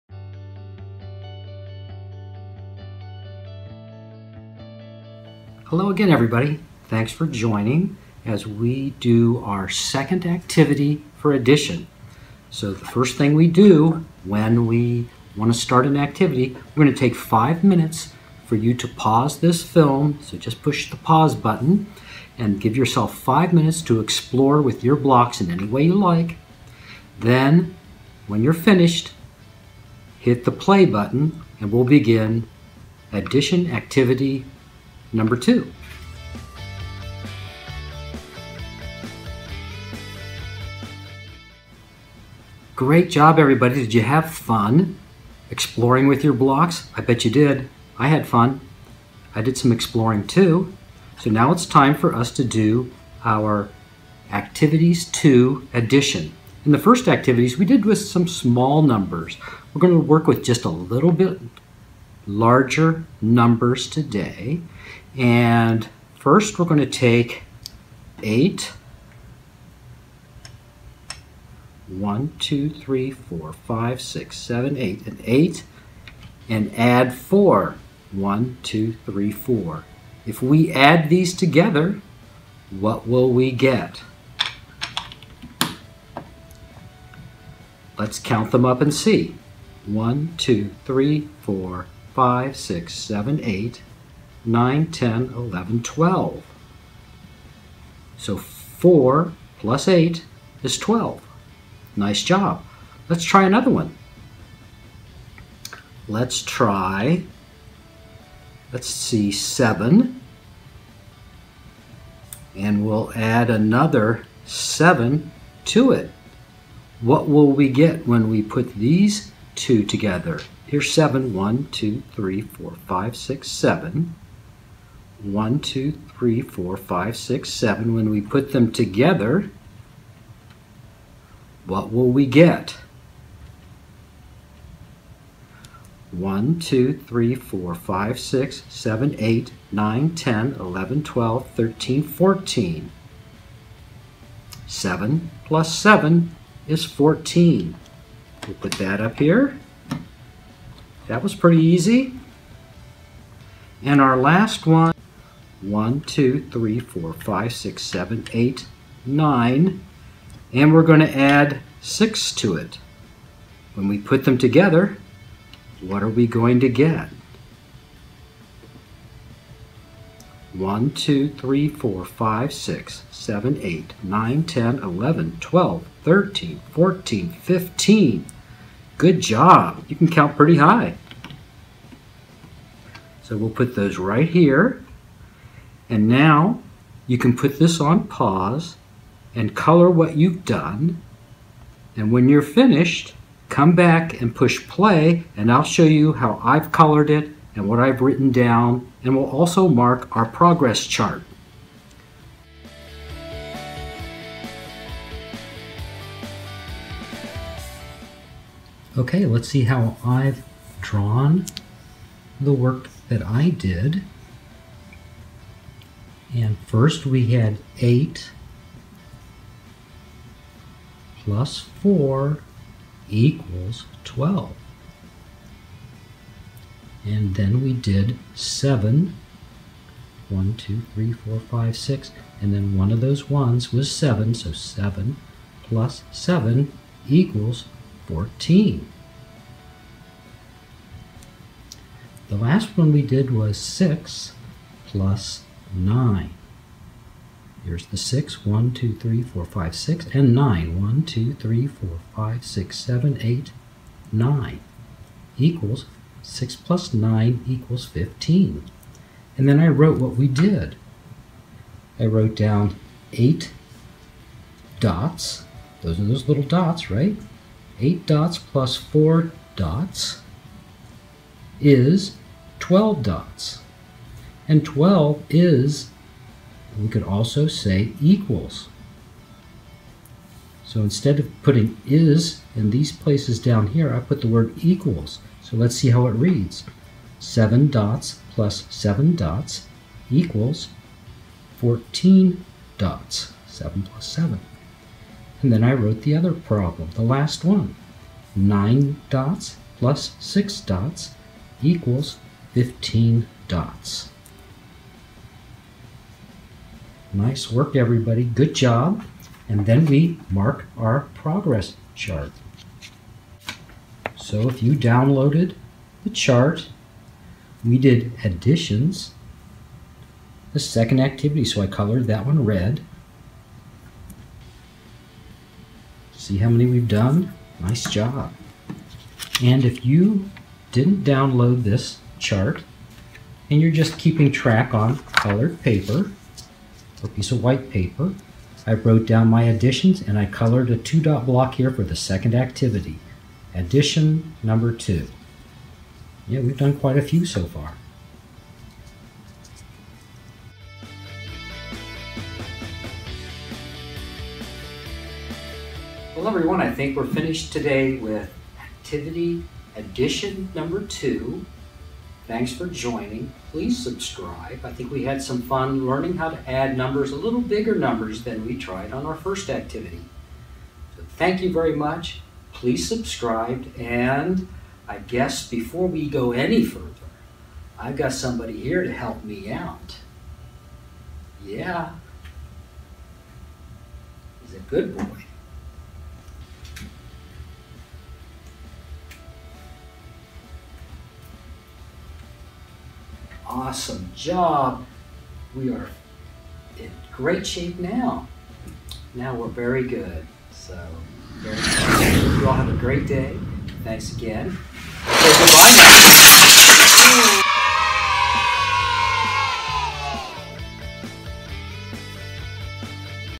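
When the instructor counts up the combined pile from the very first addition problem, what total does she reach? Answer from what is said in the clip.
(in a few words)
12.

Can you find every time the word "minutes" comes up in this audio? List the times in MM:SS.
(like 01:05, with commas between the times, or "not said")
00:17, 00:23.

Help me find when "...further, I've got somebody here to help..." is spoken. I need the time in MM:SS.
06:16.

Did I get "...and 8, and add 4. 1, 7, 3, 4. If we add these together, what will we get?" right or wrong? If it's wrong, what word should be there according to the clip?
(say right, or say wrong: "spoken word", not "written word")
wrong: "2", not "7".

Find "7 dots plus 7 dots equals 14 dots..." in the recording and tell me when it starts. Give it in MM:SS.
04:47.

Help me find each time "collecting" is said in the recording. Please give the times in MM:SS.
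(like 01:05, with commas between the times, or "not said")
not said.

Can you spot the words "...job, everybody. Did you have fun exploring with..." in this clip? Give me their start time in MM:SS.
00:43.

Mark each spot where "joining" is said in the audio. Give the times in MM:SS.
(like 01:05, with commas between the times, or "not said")
00:07, 06:02.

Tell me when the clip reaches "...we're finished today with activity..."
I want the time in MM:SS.
05:56.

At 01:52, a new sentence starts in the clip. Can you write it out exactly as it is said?
And we'll add another 7 to it.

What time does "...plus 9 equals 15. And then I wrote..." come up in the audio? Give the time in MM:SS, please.
04:16.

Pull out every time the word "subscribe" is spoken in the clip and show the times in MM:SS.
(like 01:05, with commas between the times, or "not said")
06:03, 06:12.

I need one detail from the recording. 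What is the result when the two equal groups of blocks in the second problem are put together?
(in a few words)
14.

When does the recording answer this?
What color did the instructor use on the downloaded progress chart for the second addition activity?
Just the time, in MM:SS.
05:22.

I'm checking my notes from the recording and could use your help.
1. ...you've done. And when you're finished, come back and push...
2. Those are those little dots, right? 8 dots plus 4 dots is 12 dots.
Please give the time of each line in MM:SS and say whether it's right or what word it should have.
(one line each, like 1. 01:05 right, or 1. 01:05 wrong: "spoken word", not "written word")
1. 03:10 right
2. 04:25 right.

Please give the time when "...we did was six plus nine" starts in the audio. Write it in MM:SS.
04:02.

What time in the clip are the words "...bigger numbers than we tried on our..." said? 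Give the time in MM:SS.
06:07.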